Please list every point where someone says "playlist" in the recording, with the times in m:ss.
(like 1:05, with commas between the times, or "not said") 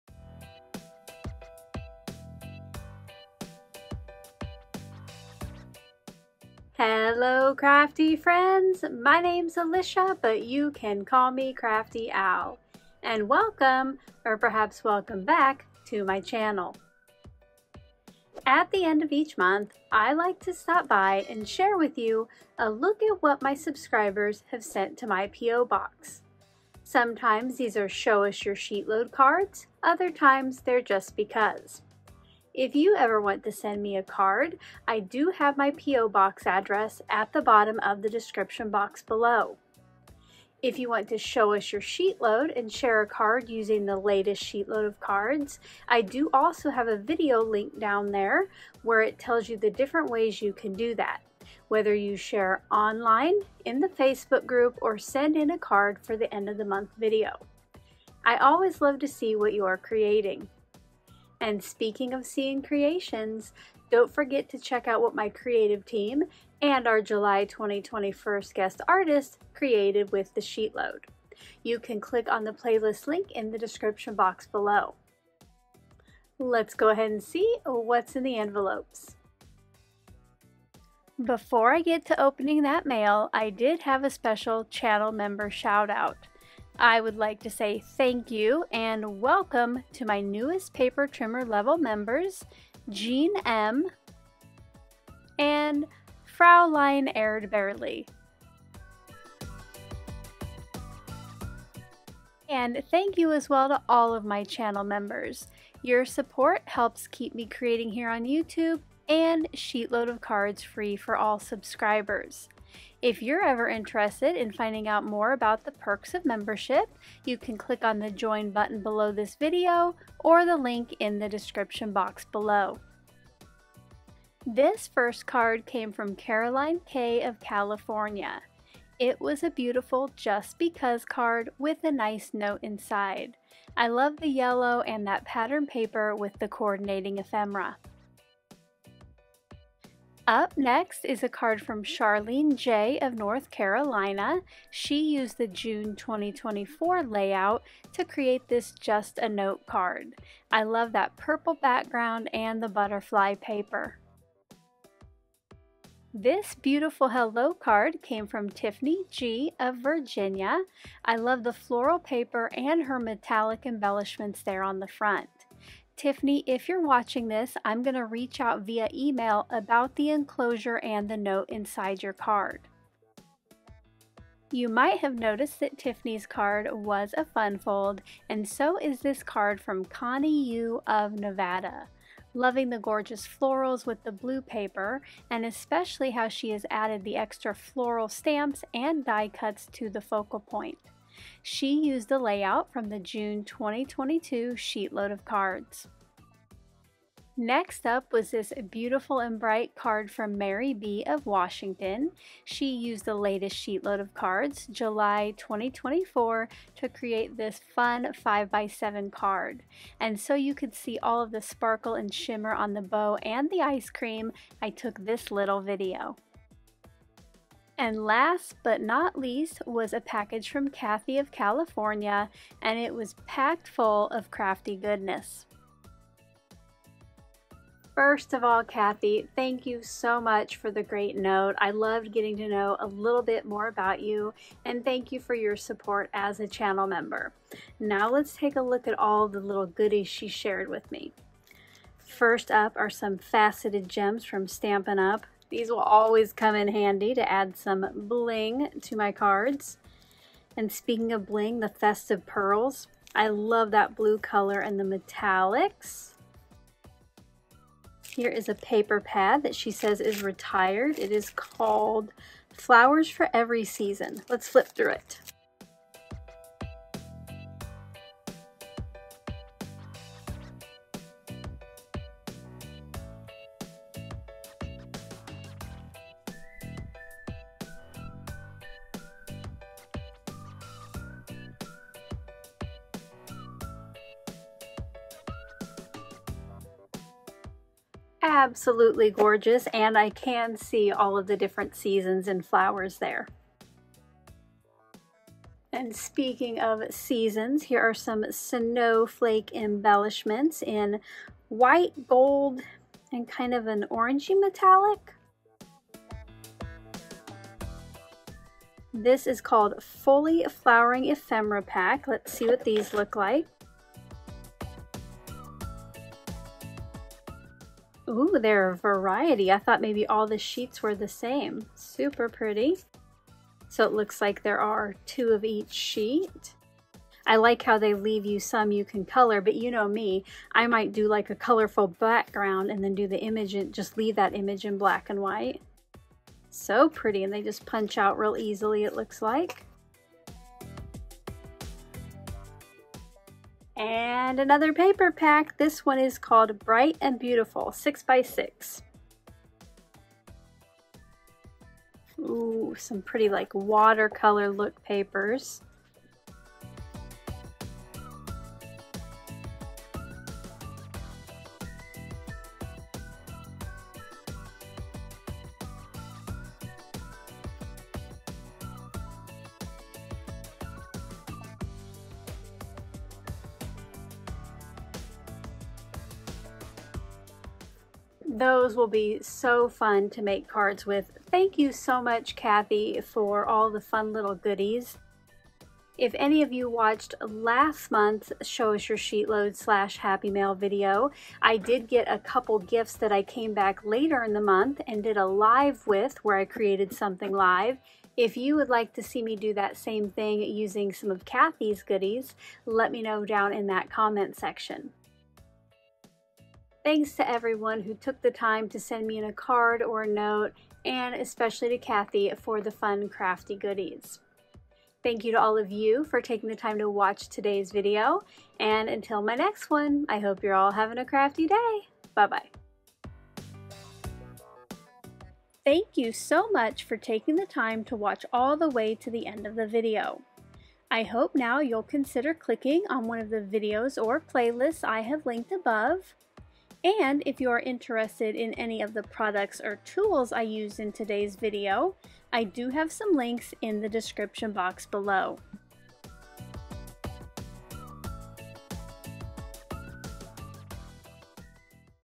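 1:12, 7:14.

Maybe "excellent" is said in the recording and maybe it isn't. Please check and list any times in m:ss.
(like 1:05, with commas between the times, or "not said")
not said.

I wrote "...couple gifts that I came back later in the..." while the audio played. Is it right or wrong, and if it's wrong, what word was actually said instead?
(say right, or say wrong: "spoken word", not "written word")
right.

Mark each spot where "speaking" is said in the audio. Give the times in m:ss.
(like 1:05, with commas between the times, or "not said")
1:01, 4:10, 4:55.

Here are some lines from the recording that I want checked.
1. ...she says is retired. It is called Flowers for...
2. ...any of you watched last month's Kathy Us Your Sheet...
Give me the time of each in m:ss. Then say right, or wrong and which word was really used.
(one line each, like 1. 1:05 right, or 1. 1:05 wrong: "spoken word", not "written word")
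1. 4:19 right
2. 6:26 wrong: "Show", not "Kathy".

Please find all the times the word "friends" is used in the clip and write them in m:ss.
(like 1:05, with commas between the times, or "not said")
0:08.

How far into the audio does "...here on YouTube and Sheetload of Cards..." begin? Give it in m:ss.
1:47.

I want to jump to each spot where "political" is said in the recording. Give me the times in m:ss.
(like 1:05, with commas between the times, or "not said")
not said.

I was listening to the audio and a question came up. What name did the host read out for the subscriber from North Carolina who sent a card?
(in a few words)
Charlene J.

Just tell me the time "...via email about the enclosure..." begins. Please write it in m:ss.
2:48.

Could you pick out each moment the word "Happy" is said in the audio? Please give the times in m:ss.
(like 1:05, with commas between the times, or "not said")
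6:29.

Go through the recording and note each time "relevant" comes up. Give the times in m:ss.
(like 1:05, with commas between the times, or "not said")
not said.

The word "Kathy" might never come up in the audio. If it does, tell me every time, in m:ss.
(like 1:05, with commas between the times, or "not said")
3:40, 3:48, 6:22, 6:41, 6:51.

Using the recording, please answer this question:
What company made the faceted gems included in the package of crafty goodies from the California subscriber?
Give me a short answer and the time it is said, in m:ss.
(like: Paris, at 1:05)
Stampin' Up, at 4:04.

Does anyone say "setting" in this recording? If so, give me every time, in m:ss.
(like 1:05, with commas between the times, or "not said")
not said.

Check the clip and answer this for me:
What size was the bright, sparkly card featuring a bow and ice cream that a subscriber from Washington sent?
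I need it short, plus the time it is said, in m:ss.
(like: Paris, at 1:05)
5x7, at 3:28.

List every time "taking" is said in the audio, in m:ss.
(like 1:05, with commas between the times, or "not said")
6:56, 7:06.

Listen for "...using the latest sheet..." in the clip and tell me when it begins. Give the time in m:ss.
0:43.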